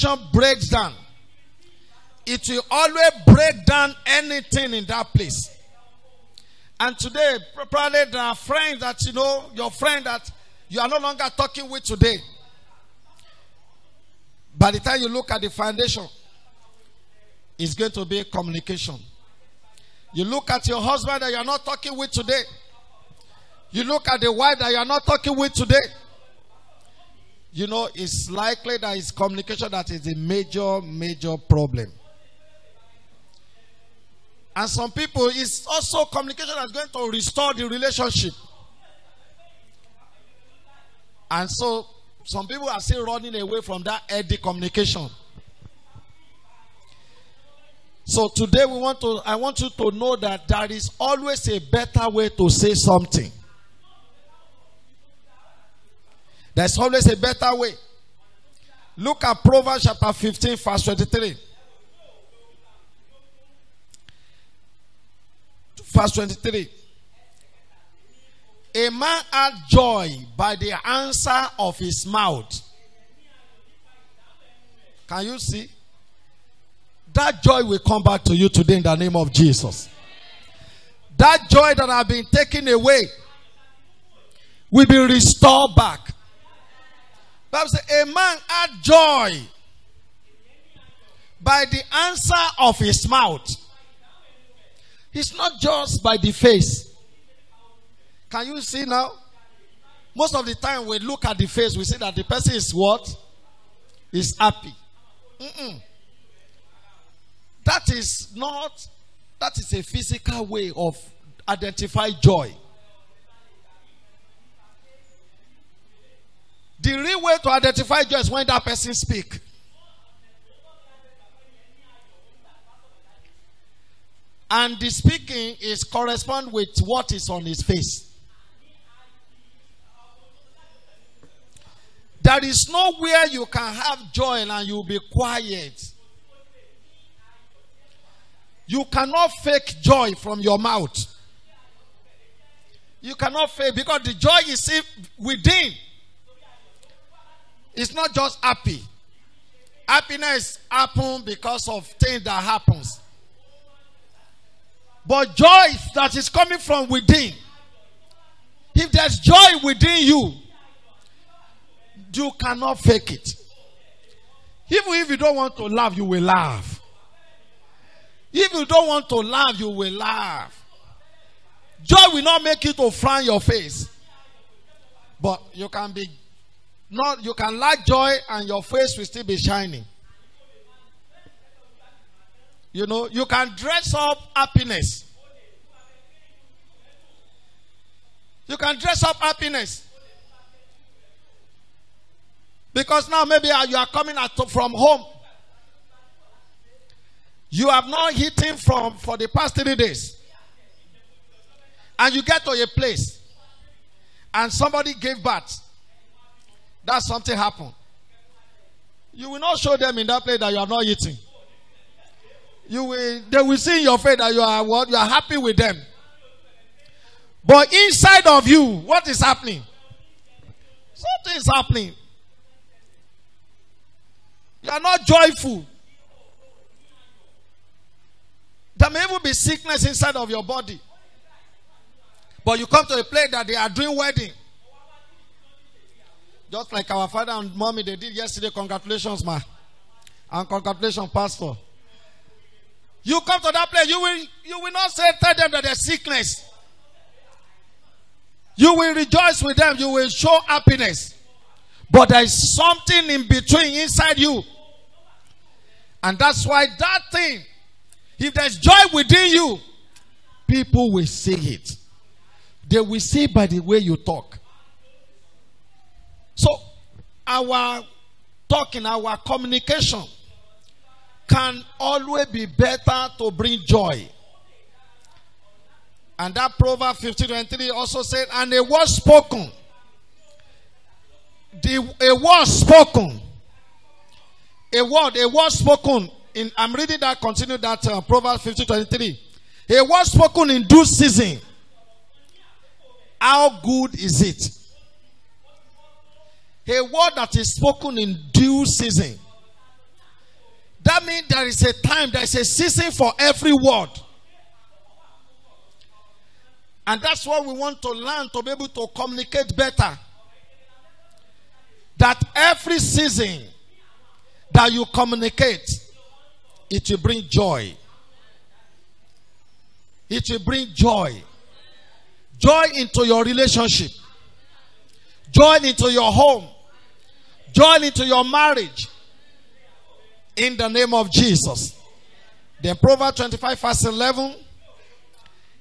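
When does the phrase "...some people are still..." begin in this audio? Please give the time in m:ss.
0:42.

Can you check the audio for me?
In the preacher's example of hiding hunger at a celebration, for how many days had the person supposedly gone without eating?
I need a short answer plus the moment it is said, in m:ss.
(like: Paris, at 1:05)
3 days, at 3:19.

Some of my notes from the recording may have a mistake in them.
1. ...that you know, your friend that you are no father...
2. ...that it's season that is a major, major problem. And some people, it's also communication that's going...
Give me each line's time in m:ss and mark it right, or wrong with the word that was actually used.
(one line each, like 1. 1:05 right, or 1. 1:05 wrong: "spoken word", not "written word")
1. 0:08 wrong: "longer", not "father"
2. 0:28 wrong: "communication", not "season".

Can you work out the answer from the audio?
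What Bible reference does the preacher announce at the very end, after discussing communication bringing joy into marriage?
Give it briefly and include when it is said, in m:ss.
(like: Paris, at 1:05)
Proverbs 25:11, at 5:32.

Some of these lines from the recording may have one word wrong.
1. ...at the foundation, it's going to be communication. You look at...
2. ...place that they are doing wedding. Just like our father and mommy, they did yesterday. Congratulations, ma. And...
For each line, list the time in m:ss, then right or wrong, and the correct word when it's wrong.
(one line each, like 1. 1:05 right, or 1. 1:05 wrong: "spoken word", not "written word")
1. 0:15 right
2. 3:53 right.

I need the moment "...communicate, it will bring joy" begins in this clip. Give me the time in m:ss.
5:14.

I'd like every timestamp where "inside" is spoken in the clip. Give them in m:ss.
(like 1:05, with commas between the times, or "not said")
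3:37, 3:49, 4:13.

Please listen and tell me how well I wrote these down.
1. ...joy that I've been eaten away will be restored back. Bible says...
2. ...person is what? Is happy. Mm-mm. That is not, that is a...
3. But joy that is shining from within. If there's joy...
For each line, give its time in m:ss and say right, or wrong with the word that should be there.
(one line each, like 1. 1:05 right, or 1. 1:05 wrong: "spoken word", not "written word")
1. 1:21 wrong: "taken", not "eaten"
2. 1:42 right
3. 2:35 wrong: "coming", not "shining".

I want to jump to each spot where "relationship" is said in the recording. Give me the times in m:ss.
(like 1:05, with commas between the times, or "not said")
0:37, 5:23.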